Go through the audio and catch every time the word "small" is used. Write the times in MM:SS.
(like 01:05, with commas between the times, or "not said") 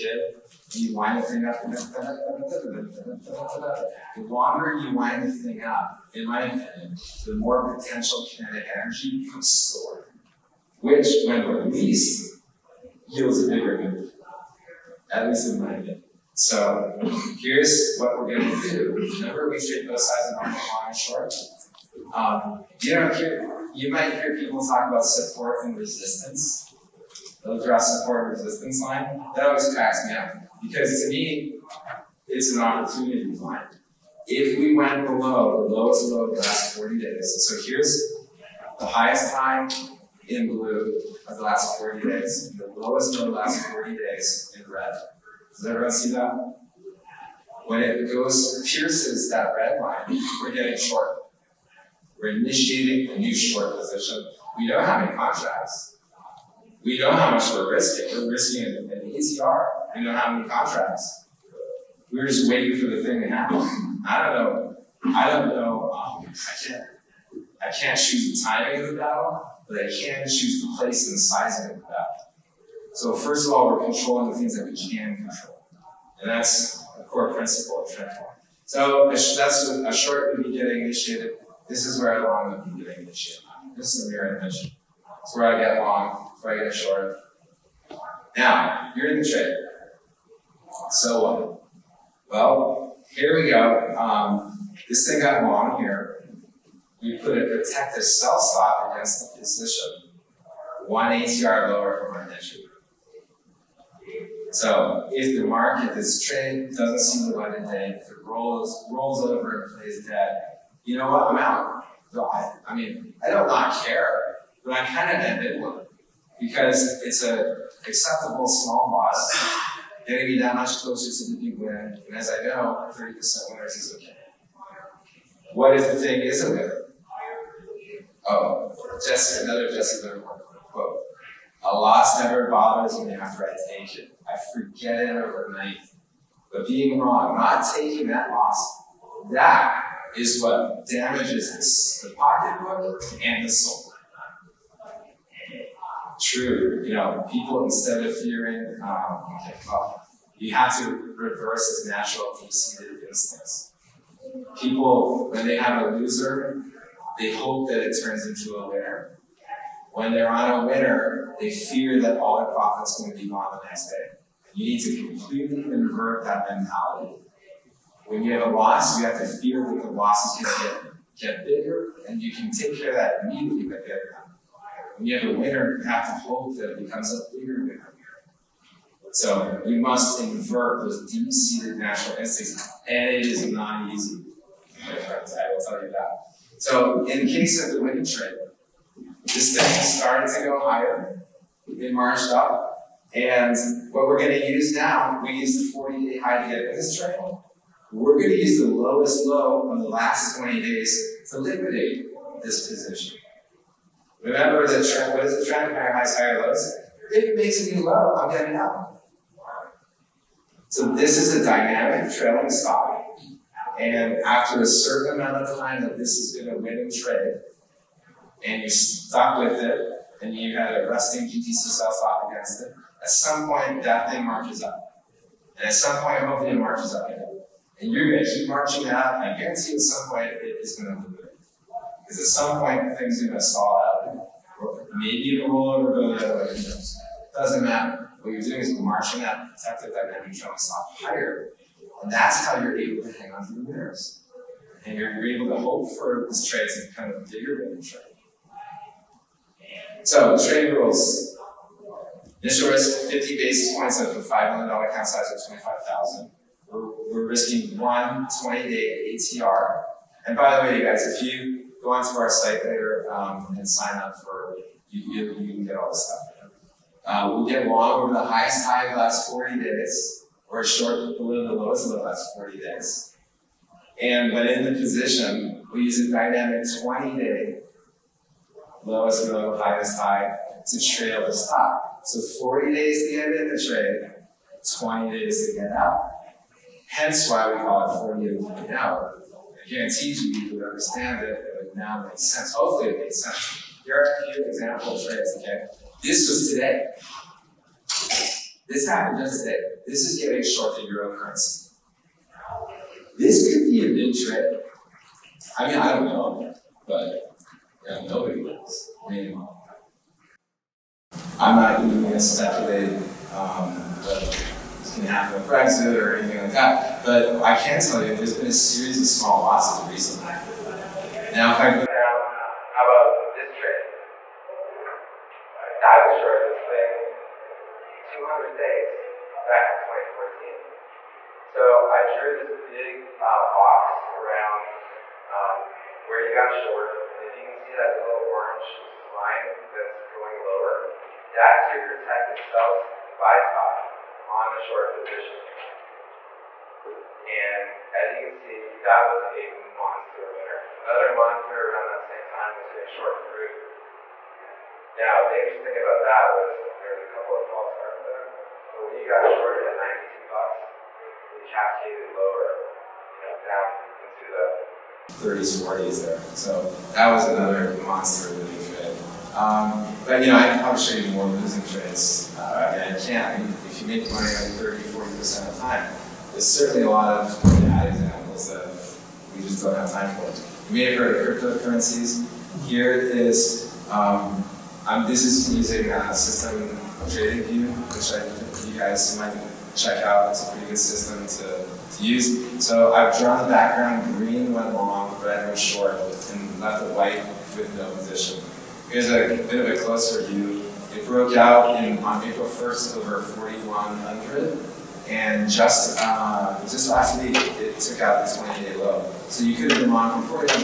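01:58, 05:19.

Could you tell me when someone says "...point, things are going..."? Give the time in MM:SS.
03:52.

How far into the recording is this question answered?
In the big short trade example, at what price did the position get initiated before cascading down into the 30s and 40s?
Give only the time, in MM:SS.
05:59.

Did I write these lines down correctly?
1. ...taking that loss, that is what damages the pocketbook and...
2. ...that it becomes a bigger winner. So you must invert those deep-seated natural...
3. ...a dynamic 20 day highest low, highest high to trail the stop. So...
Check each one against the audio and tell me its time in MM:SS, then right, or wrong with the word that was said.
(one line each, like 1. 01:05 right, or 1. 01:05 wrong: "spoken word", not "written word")
1. 02:17 right
2. 02:56 right
3. 04:36 wrong: "lowest", not "highest".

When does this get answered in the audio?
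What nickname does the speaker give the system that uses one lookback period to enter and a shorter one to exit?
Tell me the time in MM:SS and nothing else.
04:48.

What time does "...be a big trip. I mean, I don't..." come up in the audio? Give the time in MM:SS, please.
05:03.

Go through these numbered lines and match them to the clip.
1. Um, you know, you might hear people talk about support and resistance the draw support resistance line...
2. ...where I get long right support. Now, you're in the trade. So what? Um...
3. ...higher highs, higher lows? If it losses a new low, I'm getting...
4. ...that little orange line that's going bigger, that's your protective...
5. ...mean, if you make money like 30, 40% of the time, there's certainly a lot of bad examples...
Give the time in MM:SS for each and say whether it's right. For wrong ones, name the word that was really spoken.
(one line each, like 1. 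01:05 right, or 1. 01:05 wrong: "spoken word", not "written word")
1. 00:22 right
2. 01:25 wrong: "short", not "support"
3. 03:25 wrong: "makes", not "losses"
4. 05:37 wrong: "lower", not "bigger"
5. 06:13 right.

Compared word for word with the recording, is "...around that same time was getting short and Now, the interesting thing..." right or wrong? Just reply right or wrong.
right.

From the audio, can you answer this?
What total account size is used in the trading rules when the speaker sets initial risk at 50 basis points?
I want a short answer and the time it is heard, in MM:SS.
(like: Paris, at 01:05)
$5 million, at 04:14.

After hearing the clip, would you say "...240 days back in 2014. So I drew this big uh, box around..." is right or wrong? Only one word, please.
wrong.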